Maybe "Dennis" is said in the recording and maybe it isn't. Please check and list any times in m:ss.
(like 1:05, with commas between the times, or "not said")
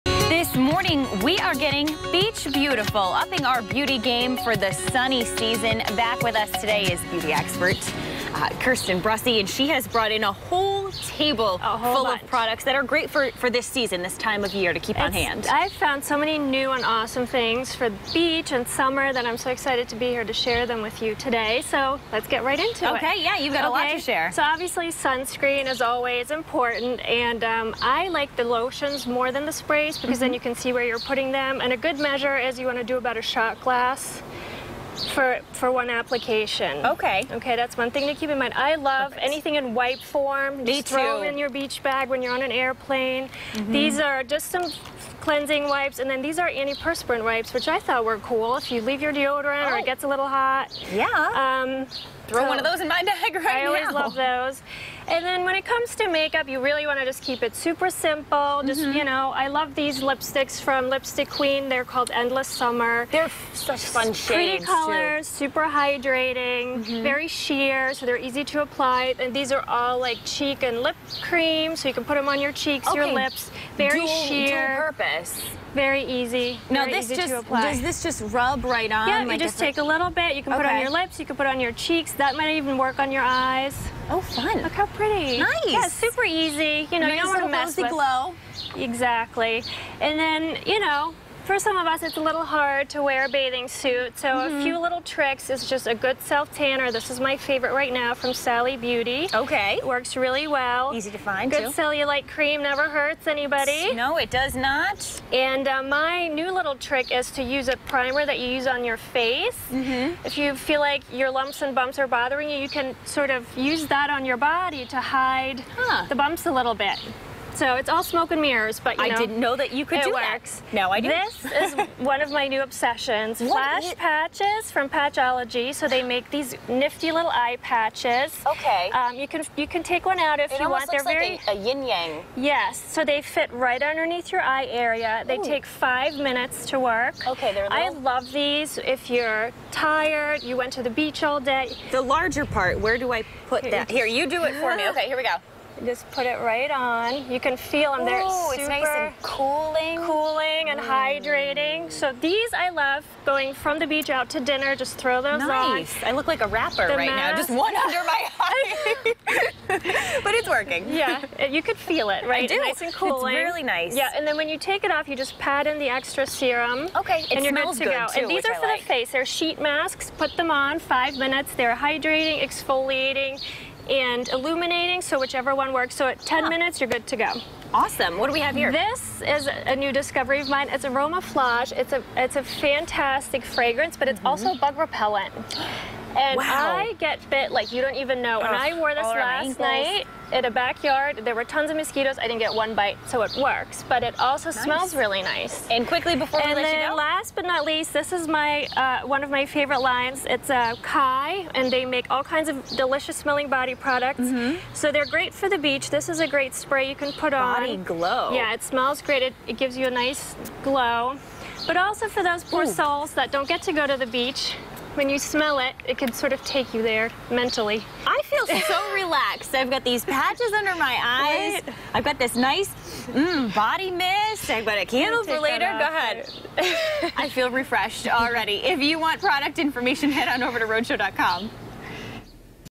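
not said.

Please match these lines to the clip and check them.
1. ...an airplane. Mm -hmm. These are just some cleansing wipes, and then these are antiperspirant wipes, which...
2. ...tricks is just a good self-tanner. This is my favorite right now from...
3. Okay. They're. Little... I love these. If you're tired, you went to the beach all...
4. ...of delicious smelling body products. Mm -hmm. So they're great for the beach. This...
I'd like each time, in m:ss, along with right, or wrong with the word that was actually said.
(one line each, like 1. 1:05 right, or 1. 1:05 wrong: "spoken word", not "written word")
1. 0:42 right
2. 1:35 right
3. 2:17 right
4. 3:22 right.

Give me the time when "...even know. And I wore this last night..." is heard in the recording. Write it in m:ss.
3:07.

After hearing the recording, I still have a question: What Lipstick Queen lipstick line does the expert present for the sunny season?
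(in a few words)
Endless Summer.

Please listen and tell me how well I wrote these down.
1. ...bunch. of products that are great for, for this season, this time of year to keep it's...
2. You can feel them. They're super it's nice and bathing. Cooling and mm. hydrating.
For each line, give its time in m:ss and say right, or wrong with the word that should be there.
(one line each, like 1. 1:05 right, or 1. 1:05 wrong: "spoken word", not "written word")
1. 0:12 right
2. 2:27 wrong: "cooling", not "bathing".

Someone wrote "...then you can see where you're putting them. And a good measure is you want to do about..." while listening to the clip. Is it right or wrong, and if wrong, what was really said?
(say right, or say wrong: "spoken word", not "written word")
right.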